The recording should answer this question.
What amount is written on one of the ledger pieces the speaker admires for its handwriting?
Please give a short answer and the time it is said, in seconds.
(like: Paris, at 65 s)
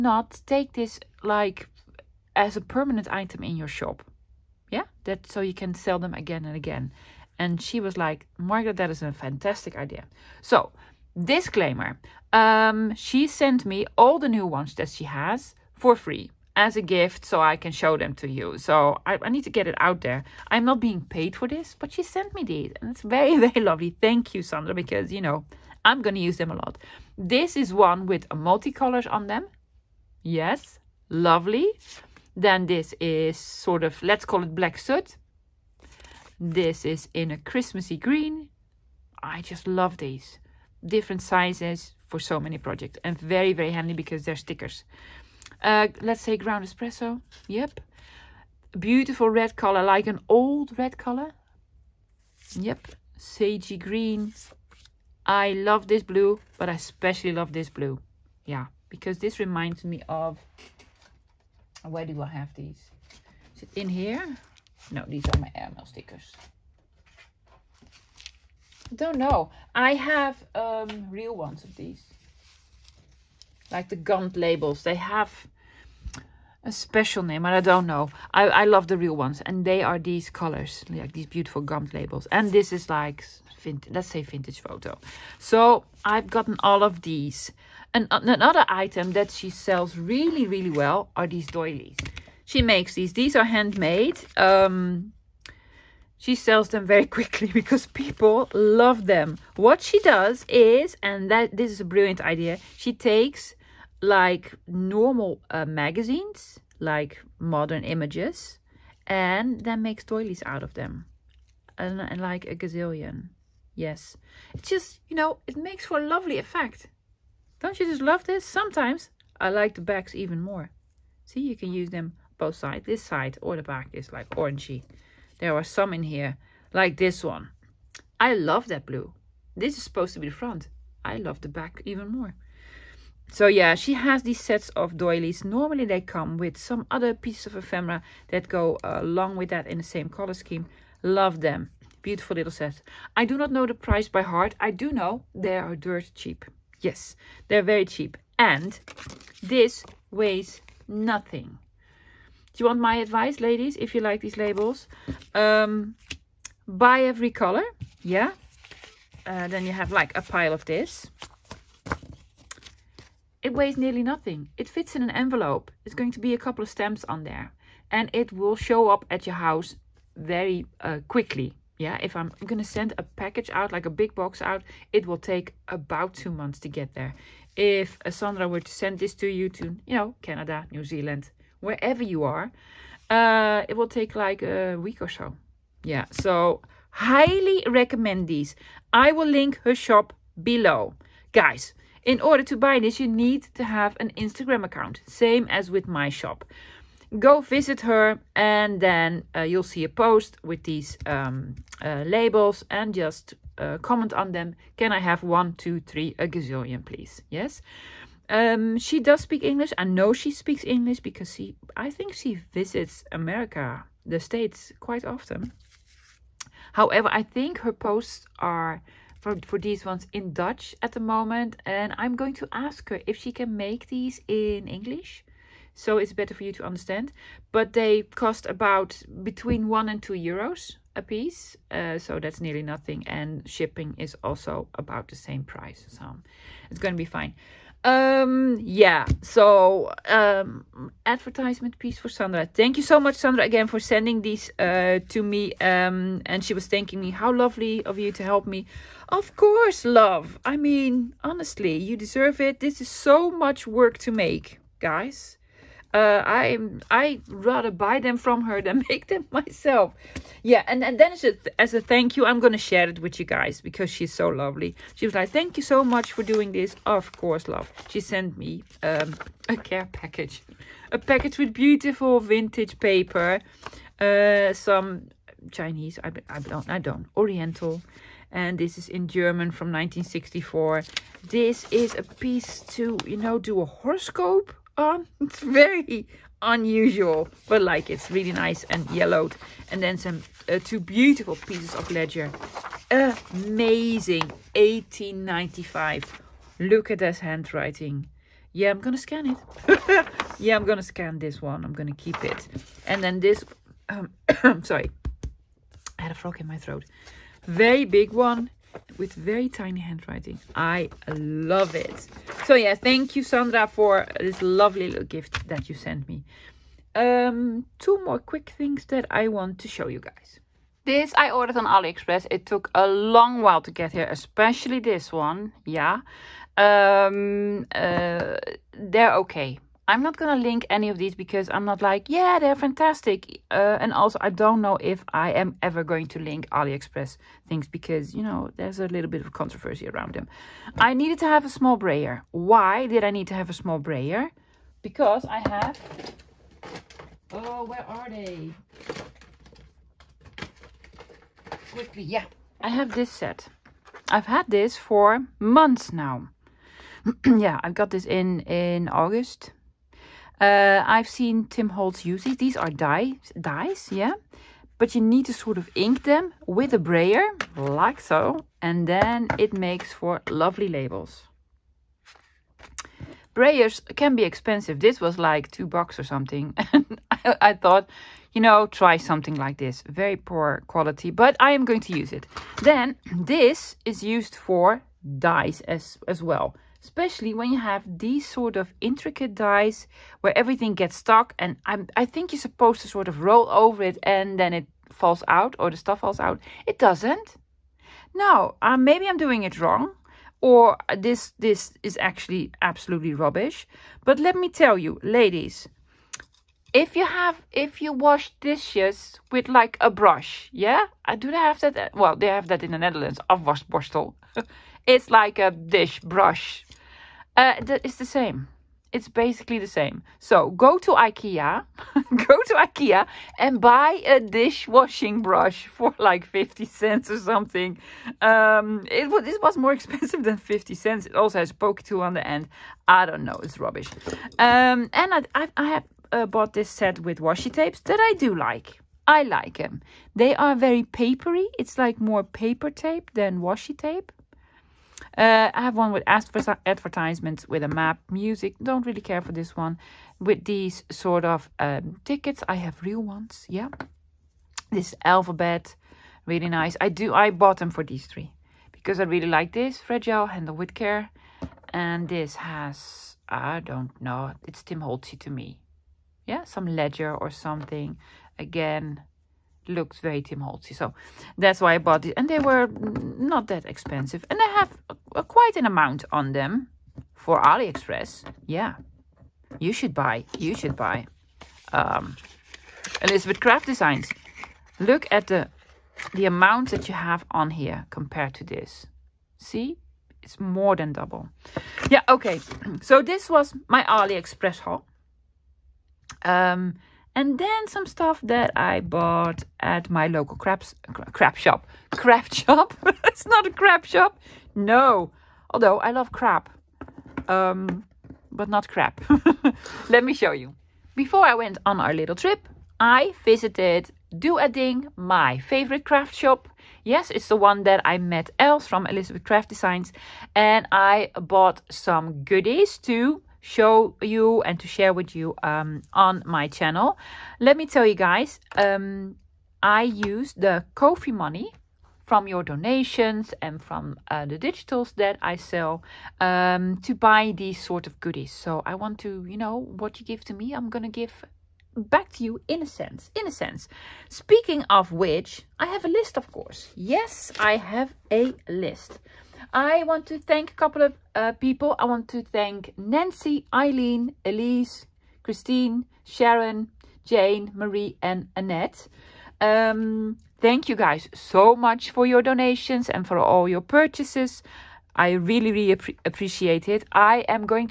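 18.95, at 294 s.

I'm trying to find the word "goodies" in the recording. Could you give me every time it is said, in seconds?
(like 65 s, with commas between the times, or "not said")
522 s, 537 s.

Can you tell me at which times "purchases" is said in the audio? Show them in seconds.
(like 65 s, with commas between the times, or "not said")
563 s.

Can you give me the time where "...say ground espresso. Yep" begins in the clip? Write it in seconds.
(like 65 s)
46 s.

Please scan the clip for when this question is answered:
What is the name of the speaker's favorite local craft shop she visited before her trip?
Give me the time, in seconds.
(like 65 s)
514 s.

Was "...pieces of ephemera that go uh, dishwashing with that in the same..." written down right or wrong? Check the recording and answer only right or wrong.
wrong.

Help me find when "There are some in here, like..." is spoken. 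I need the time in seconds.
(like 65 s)
125 s.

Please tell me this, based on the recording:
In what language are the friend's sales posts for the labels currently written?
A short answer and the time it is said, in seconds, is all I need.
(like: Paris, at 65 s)
Dutch, at 220 s.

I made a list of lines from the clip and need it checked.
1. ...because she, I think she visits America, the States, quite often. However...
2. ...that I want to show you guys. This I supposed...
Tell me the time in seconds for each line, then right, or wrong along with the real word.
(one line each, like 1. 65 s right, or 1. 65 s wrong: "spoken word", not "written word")
1. 211 s right
2. 318 s wrong: "ordered", not "supposed".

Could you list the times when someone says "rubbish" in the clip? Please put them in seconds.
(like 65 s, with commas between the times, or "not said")
403 s, 433 s.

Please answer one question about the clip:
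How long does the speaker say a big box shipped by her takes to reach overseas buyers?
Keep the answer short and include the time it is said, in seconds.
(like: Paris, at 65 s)
About two months, at 176 s.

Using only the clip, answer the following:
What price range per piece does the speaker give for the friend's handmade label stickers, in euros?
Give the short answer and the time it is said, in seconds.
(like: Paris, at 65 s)
1 to 2 euros, at 229 s.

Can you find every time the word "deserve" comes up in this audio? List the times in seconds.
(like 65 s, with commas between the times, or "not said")
251 s.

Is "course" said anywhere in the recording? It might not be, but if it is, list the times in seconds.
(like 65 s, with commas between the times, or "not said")
249 s, 267 s, 546 s.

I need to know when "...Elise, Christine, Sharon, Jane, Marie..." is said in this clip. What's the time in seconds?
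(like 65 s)
554 s.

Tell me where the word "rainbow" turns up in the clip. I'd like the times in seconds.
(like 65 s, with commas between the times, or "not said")
not said.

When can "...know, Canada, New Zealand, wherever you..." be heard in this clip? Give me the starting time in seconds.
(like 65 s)
179 s.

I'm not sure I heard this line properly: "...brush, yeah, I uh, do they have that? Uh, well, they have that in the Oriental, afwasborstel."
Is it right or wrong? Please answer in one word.
wrong.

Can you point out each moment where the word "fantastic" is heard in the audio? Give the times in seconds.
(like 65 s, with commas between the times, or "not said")
9 s, 332 s.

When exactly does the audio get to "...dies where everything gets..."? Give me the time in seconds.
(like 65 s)
389 s.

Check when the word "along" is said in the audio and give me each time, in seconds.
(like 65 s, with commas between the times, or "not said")
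139 s.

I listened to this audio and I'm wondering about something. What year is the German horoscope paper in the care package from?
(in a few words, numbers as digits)
1964.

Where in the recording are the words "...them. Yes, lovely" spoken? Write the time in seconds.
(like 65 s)
29 s.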